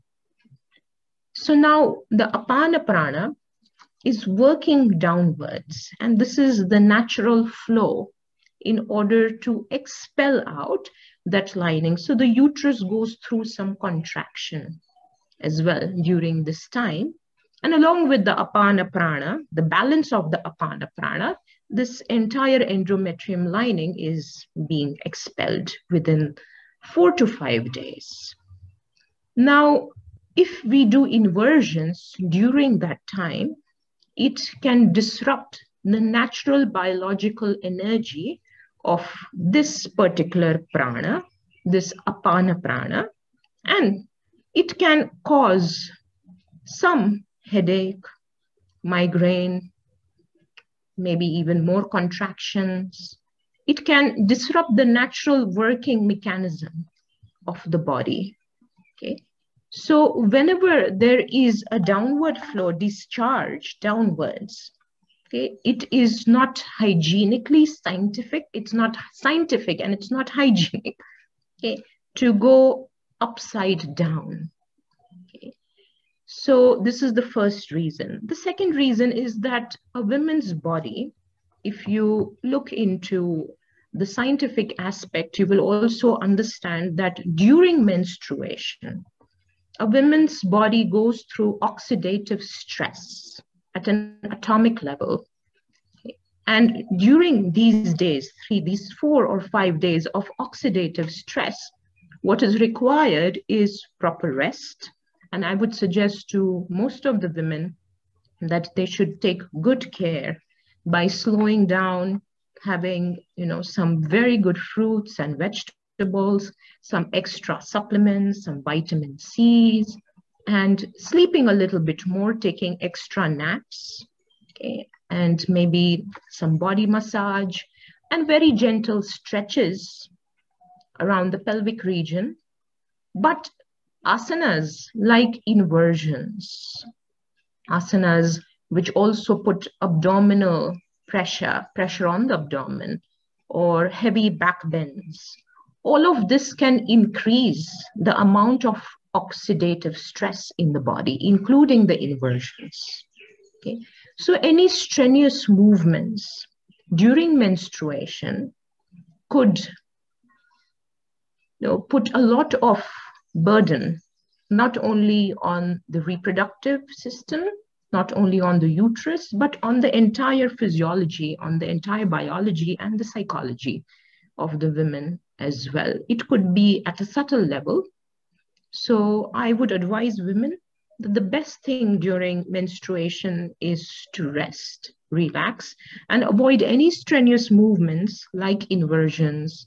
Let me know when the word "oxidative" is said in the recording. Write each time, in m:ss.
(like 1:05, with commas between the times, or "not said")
1:31, 1:40, 2:29.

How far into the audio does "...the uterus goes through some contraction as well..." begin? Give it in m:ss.
0:12.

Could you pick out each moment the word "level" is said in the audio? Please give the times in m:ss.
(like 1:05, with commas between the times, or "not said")
1:34, 2:57.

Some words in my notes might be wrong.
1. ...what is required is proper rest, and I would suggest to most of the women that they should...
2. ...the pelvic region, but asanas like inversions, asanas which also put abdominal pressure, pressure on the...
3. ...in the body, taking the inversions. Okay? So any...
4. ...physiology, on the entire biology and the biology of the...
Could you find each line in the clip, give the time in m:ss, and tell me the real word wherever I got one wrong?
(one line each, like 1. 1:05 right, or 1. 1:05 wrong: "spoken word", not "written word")
1. 1:42 right
2. 2:11 right
3. 2:30 wrong: "including", not "taking"
4. 2:50 wrong: "psychology", not "biology".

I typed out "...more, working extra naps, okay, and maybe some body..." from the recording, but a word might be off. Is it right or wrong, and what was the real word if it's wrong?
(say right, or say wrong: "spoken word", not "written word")
wrong: "taking", not "working".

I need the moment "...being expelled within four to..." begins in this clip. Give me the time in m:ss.
0:24.